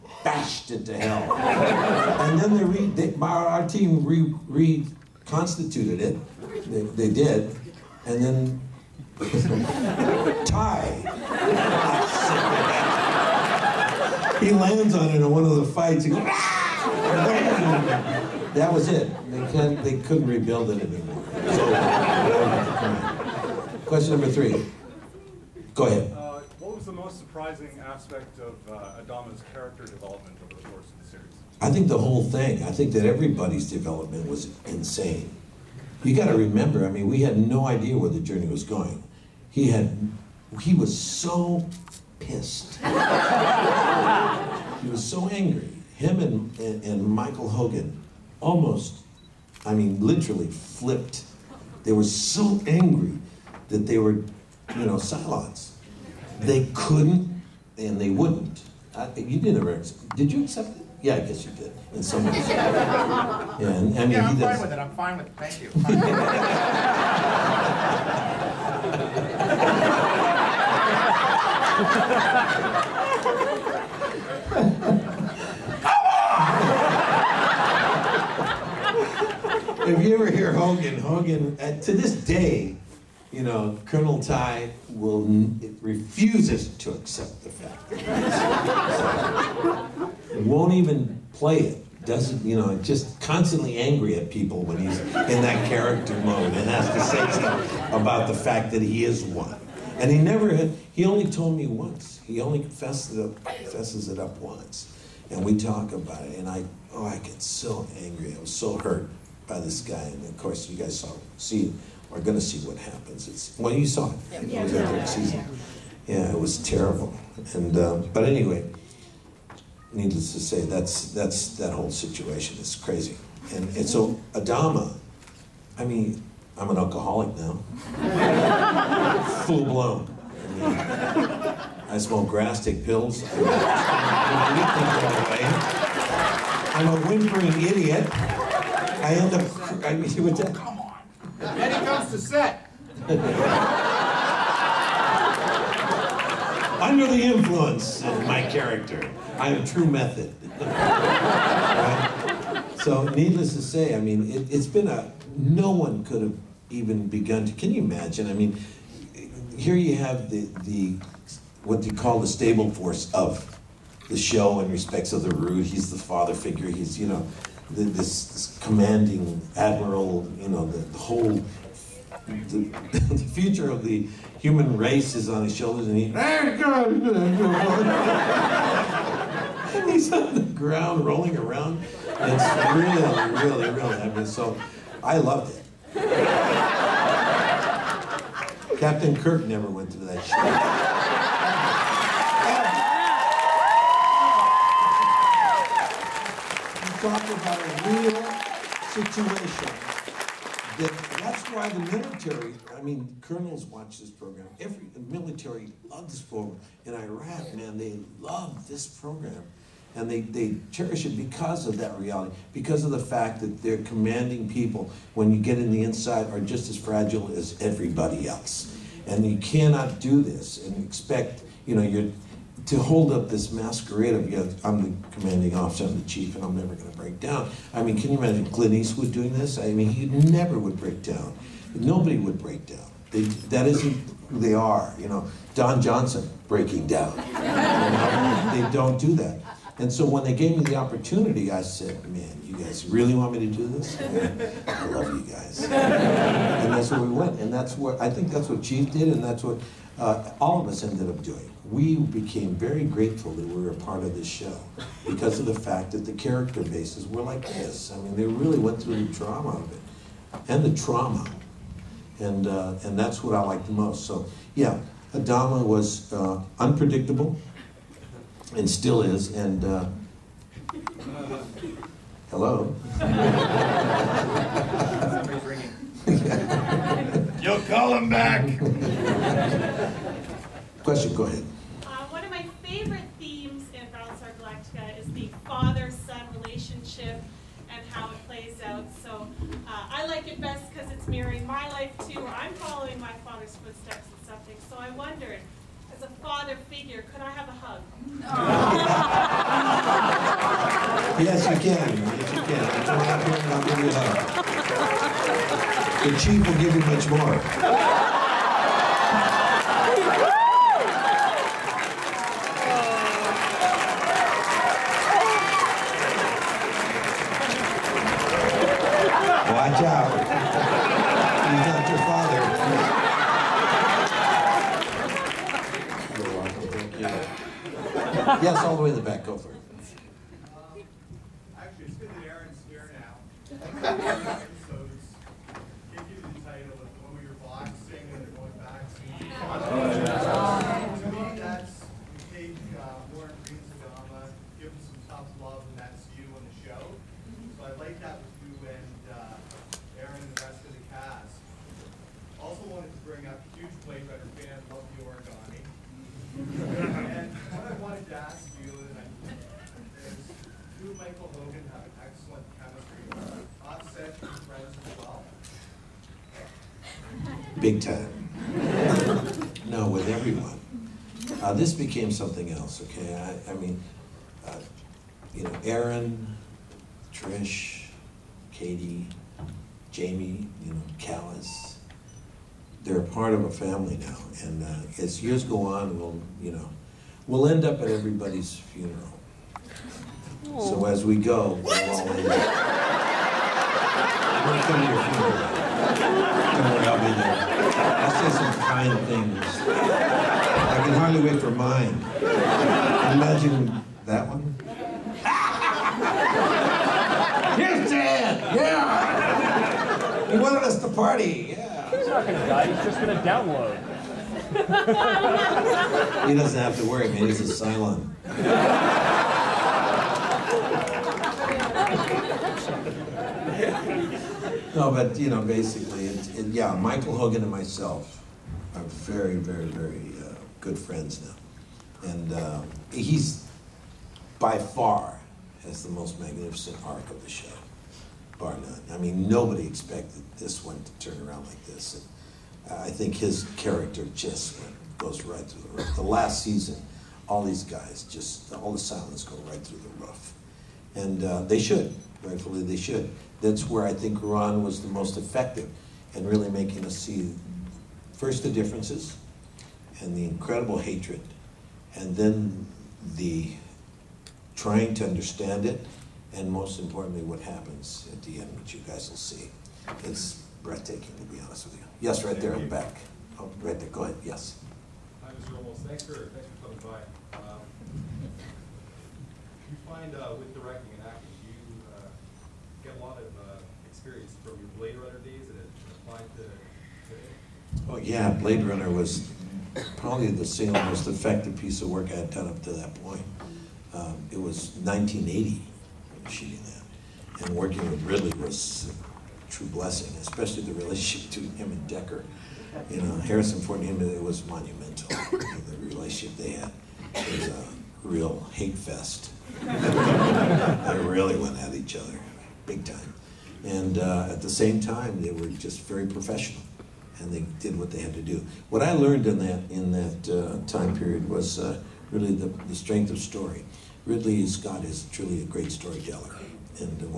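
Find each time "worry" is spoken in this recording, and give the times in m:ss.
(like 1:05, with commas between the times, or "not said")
6:35, 6:56.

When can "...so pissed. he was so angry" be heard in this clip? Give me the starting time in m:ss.
0:41.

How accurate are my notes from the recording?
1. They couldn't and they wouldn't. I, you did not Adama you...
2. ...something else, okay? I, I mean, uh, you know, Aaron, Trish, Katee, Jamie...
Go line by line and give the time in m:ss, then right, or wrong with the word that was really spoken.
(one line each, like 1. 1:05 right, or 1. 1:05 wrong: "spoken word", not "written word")
1. 0:56 wrong: "Did", not "Adama"
2. 6:12 right.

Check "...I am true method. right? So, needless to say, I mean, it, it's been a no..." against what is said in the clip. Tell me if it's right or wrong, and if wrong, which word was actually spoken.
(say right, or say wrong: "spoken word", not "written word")
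right.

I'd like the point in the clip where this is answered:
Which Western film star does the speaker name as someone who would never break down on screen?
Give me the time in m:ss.
3:48.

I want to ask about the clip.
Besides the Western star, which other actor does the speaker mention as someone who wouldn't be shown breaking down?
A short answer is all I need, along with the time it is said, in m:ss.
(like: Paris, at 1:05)
Don Johnson, at 3:55.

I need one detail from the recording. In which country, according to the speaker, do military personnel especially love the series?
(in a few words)
Iraq.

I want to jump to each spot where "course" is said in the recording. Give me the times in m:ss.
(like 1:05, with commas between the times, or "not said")
0:30, 1:50.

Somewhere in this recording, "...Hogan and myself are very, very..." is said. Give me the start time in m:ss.
7:07.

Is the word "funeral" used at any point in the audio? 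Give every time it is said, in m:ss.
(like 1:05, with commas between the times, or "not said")
6:28, 6:35.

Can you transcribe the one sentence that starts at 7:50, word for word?
It's breathtaking, to be honest with you.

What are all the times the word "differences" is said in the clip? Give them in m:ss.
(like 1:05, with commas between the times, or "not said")
7:38.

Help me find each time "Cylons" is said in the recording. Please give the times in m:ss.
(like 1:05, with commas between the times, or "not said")
0:54, 6:57, 7:28.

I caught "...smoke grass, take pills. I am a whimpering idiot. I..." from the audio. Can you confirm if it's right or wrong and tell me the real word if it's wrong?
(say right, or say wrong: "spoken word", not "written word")
right.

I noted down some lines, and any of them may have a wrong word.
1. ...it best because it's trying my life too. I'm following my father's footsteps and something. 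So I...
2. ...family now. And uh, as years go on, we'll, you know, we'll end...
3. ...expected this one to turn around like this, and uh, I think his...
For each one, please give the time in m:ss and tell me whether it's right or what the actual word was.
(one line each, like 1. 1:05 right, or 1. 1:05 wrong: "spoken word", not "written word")
1. 4:50 wrong: "mirroring", not "trying"
2. 6:23 right
3. 7:19 right.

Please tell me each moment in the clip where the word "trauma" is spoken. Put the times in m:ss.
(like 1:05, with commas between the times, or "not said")
4:20.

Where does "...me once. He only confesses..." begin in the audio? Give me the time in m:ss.
1:41.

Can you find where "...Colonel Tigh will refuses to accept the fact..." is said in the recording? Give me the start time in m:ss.
1:23.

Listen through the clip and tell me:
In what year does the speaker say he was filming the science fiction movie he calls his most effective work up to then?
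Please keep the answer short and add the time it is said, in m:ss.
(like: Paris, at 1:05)
1980, at 8:14.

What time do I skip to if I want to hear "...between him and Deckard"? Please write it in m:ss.
8:21.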